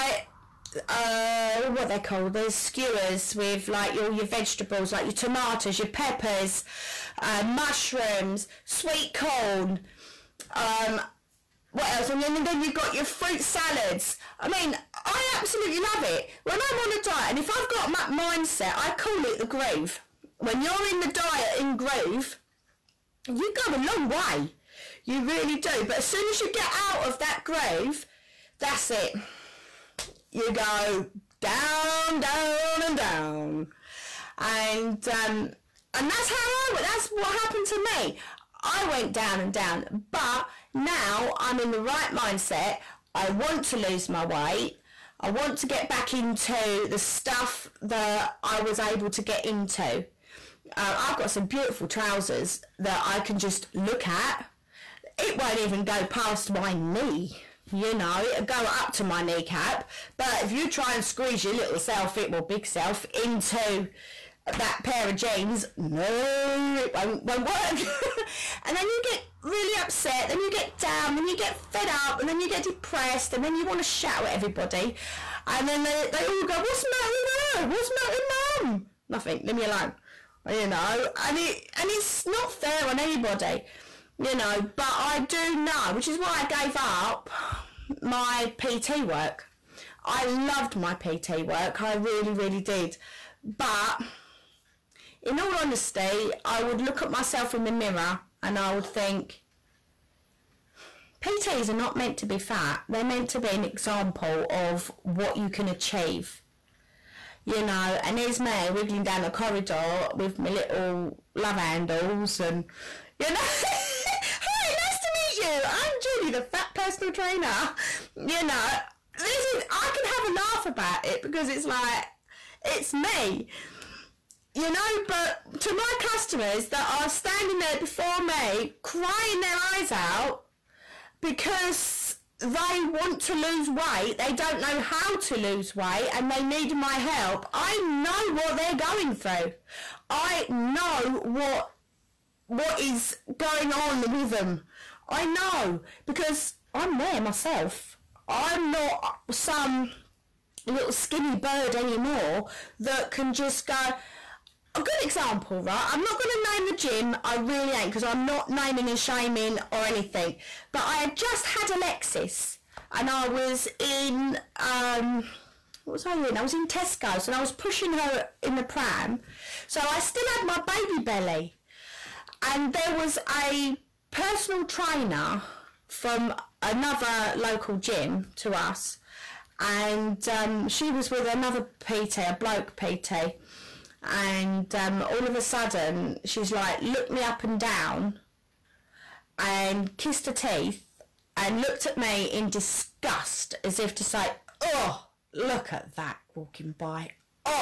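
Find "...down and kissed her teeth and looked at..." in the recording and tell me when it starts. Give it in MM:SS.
03:07.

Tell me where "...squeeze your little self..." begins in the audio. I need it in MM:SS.
01:01.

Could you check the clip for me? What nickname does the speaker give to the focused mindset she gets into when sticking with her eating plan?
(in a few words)
the groove.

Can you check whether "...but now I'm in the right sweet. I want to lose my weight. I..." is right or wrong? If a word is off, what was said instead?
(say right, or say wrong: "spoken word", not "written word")
wrong: "mindset", not "sweet".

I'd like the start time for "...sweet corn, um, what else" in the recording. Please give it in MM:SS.
00:08.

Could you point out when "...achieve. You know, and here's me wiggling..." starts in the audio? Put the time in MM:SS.
01:45.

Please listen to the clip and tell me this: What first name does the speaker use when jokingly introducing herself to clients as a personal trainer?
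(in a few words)
Julie.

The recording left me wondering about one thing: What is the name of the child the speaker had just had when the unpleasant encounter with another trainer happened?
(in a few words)
Alexis.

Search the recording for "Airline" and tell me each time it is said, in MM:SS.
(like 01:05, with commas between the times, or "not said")
not said.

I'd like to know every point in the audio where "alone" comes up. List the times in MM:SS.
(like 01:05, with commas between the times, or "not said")
01:19.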